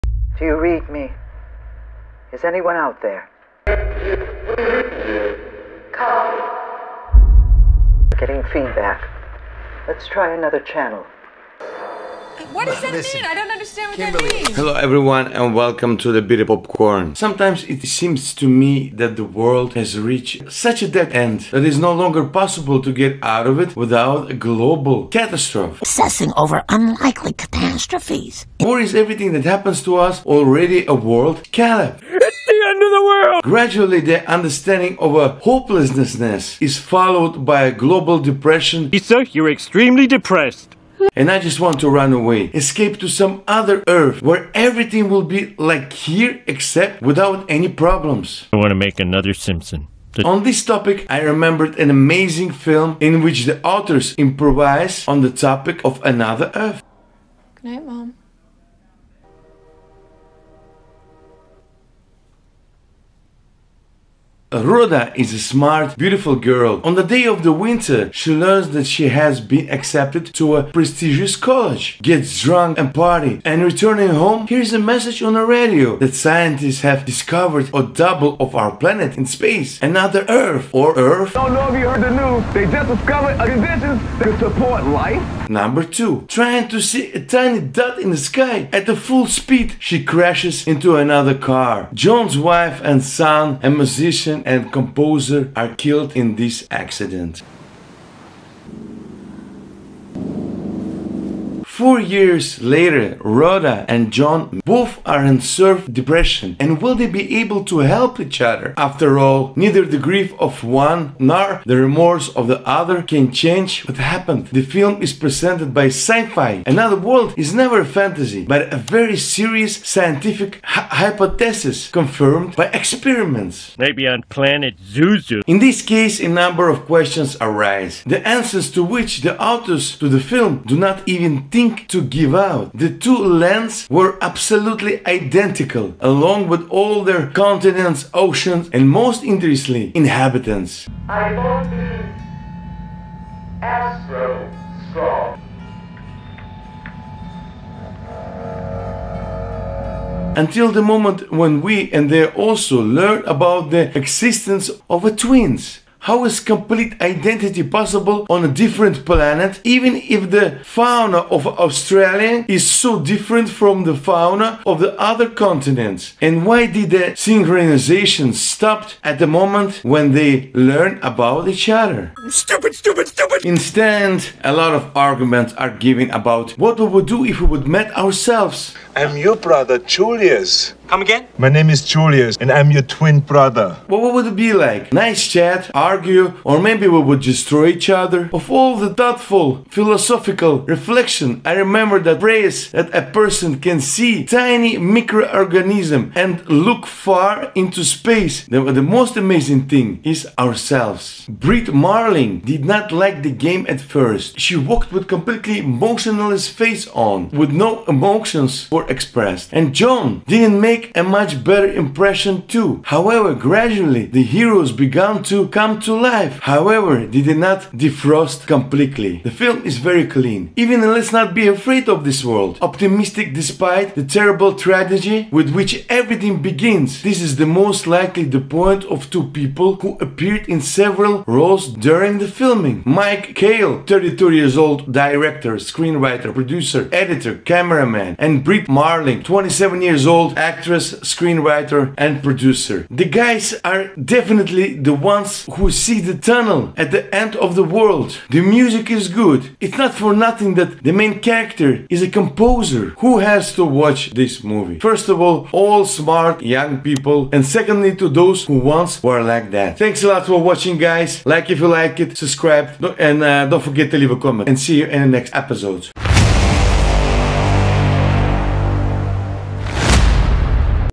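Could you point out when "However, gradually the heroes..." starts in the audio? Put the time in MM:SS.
03:32.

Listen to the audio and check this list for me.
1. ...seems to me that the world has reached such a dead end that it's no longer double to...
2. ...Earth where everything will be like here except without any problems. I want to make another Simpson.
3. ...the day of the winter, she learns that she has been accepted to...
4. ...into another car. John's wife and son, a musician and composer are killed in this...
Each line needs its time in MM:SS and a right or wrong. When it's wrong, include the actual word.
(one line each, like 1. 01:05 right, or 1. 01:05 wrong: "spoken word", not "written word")
1. 00:17 wrong: "possible", not "double"
2. 00:43 right
3. 01:06 right
4. 01:30 right.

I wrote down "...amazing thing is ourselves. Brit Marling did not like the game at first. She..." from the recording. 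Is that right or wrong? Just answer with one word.
right.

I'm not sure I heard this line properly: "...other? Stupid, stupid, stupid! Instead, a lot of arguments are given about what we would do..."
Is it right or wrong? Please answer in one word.
right.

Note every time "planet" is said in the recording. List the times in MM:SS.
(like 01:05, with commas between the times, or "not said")
01:18, 02:04, 02:39.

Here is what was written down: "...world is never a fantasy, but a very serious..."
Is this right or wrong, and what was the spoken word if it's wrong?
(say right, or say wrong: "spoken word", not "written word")
right.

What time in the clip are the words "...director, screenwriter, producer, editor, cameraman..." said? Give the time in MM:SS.
03:54.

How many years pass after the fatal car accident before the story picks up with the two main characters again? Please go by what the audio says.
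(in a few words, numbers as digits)
4.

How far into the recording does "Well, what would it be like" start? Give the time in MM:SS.
03:03.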